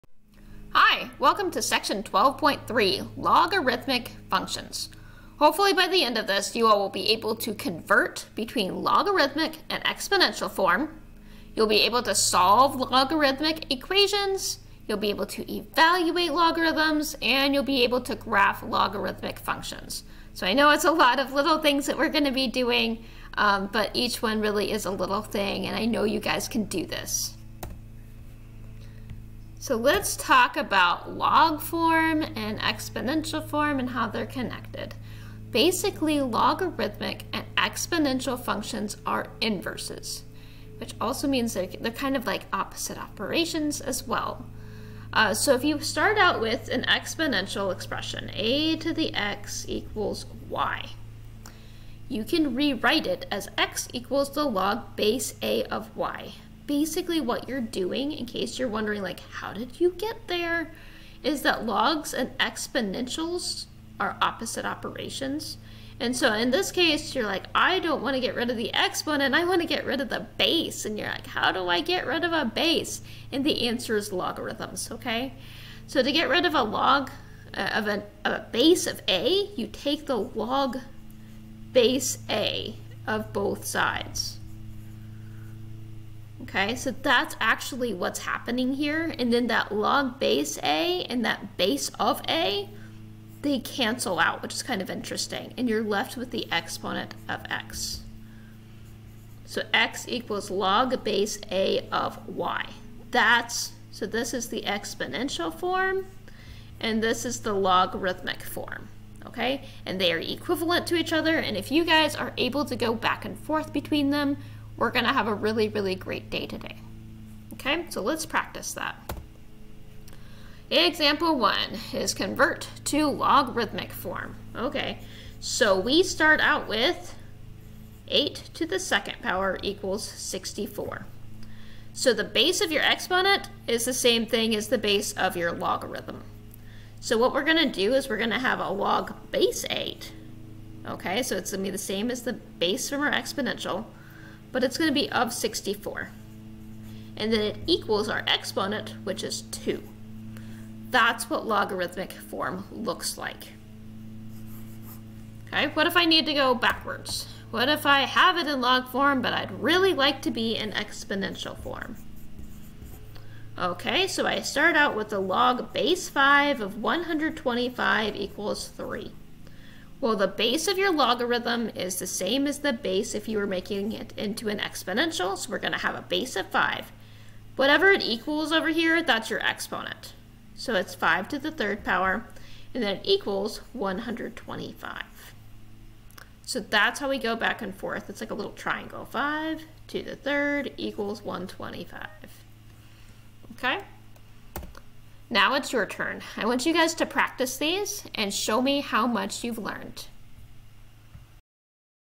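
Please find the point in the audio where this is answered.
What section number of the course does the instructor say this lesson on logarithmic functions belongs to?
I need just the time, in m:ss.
0:02.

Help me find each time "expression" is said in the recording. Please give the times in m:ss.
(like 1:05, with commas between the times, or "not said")
0:47.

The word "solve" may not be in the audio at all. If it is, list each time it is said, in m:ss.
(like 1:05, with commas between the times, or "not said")
0:12.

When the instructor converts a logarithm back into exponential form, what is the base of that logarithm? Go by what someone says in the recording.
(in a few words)
5.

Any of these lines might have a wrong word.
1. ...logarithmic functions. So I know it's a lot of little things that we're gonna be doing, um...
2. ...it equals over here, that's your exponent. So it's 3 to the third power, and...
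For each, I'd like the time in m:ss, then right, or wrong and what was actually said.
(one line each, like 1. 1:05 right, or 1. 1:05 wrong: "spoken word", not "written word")
1. 0:18 right
2. 2:57 wrong: "5", not "3".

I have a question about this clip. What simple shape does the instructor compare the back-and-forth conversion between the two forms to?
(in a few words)
triangle.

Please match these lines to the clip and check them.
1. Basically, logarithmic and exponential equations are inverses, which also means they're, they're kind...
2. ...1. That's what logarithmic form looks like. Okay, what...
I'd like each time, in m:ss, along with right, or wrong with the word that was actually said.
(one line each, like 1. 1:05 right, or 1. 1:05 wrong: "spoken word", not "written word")
1. 0:35 wrong: "functions", not "equations"
2. 2:29 wrong: "2", not "1".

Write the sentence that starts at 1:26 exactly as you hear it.
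Okay, so that's actually what's happening here.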